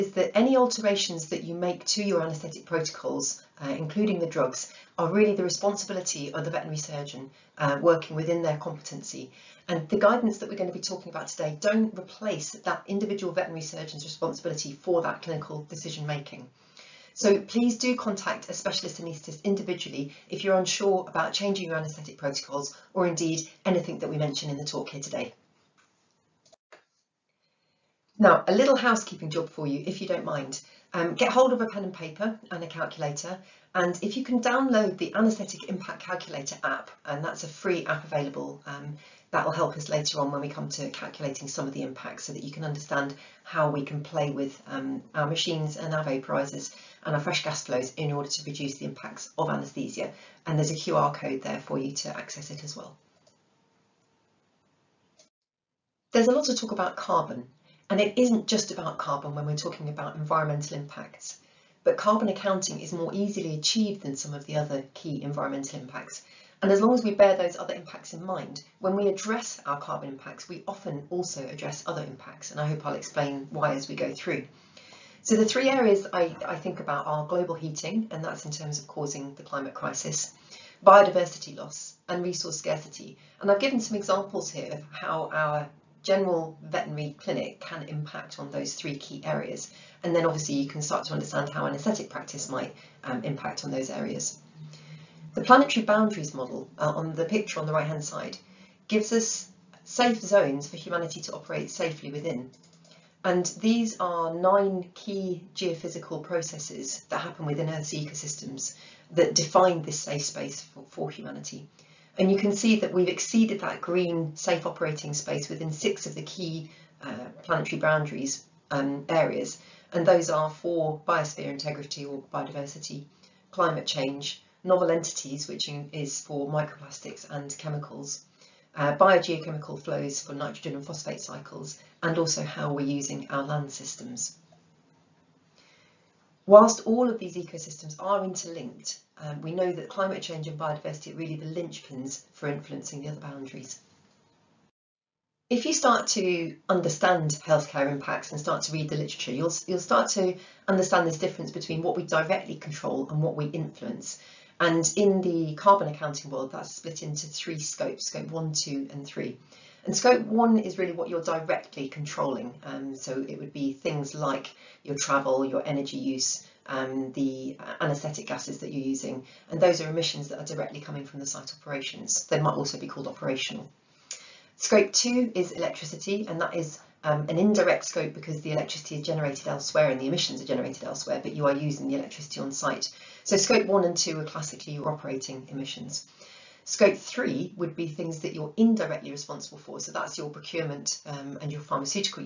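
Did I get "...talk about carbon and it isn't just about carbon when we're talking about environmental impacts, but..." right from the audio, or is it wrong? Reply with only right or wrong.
right.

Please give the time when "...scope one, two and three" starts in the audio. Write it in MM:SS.
02:38.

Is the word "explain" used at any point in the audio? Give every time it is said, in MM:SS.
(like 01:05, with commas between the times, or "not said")
01:12.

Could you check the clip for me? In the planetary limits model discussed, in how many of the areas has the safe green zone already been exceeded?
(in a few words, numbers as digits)
6.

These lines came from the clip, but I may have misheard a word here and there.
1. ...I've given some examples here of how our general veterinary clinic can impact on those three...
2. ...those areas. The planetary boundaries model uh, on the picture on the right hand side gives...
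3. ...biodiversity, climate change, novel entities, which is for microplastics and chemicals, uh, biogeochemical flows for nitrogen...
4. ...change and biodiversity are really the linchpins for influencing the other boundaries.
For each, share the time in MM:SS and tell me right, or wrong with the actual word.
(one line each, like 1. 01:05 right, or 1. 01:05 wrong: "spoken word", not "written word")
1. 01:23 right
2. 01:33 right
3. 02:02 right
4. 02:20 right.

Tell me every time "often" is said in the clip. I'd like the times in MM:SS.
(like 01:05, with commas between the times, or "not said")
01:10.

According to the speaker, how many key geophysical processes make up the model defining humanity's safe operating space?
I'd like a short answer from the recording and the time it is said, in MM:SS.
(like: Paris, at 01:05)
9, at 01:44.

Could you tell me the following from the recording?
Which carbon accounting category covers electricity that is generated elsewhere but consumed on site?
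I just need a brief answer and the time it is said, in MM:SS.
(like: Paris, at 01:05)
Scope two, at 02:54.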